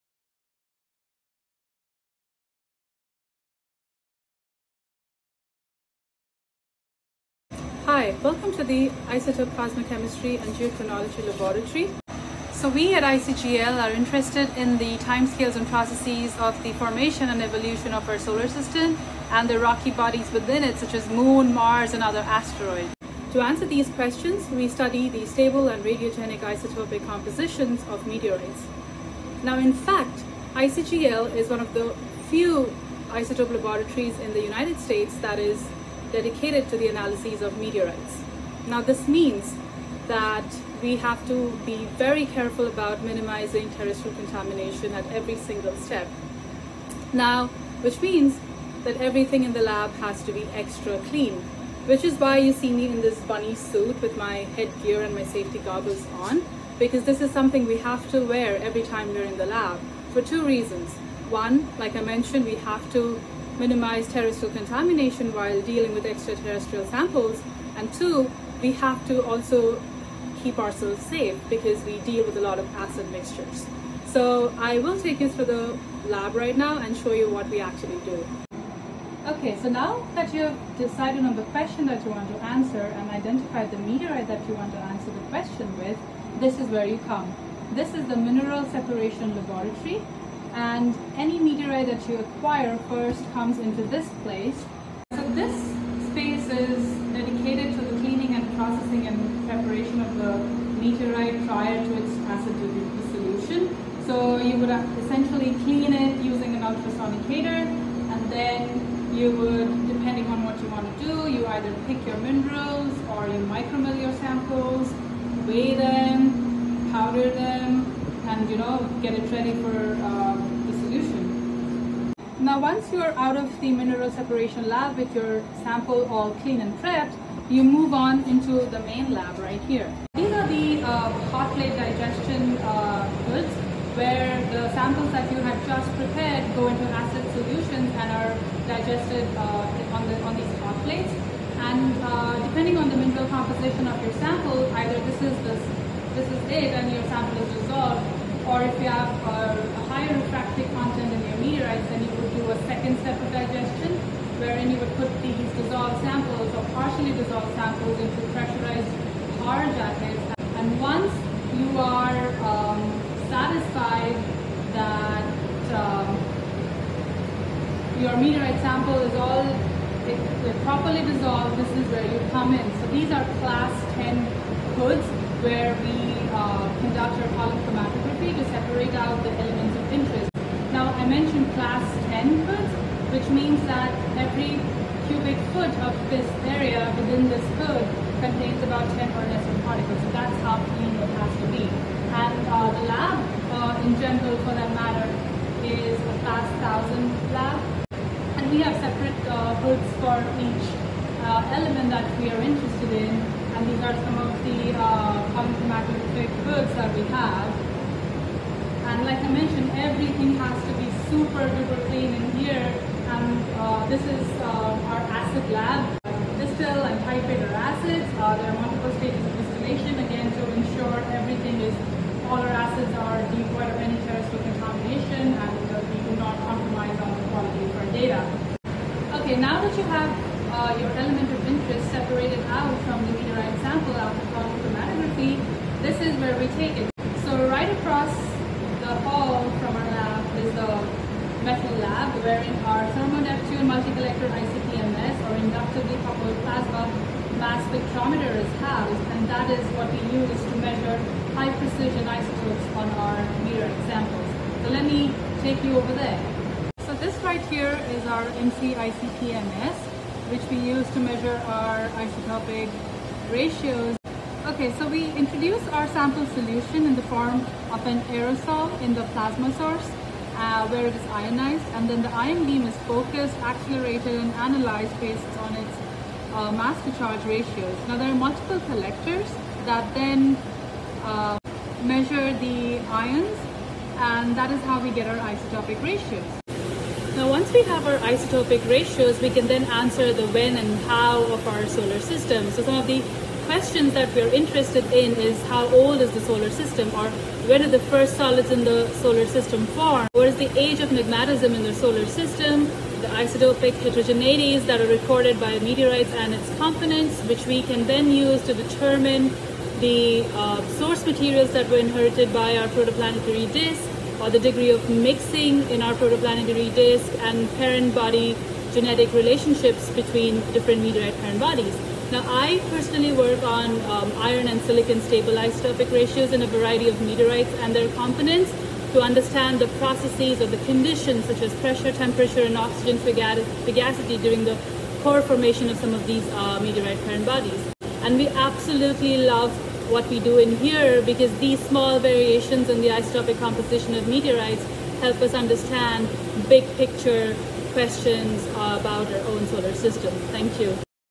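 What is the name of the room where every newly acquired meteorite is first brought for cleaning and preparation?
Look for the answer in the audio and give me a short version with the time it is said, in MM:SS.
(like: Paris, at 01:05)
Mineral Separation Laboratory, at 01:28.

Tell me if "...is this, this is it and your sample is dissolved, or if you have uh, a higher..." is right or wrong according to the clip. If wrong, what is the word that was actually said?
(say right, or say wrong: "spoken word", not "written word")
right.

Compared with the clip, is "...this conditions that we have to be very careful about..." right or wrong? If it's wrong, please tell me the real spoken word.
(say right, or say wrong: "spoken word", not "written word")
wrong: "means", not "conditions".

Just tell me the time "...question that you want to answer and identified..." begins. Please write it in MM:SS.
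01:21.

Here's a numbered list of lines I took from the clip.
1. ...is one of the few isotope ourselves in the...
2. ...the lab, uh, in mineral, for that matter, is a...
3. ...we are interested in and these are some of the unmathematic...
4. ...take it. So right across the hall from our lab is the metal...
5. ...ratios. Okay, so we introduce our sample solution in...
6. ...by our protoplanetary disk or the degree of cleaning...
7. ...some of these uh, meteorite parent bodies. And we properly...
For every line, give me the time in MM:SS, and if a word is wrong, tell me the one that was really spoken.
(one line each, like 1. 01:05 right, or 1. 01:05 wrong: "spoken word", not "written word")
1. 00:31 wrong: "laboratories", not "ourselves"
2. 03:12 wrong: "general", not "mineral"
3. 03:22 right
4. 03:56 right
5. 04:23 right
6. 05:12 wrong: "mixing", not "cleaning"
7. 05:35 wrong: "absolutely", not "properly".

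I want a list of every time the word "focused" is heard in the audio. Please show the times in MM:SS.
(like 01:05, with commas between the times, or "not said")
04:32.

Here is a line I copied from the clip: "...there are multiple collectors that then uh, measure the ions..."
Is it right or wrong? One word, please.
right.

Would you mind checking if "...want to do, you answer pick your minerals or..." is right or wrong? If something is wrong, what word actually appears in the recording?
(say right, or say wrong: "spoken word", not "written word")
wrong: "either", not "answer".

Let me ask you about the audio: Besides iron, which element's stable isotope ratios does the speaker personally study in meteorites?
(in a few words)
silicon.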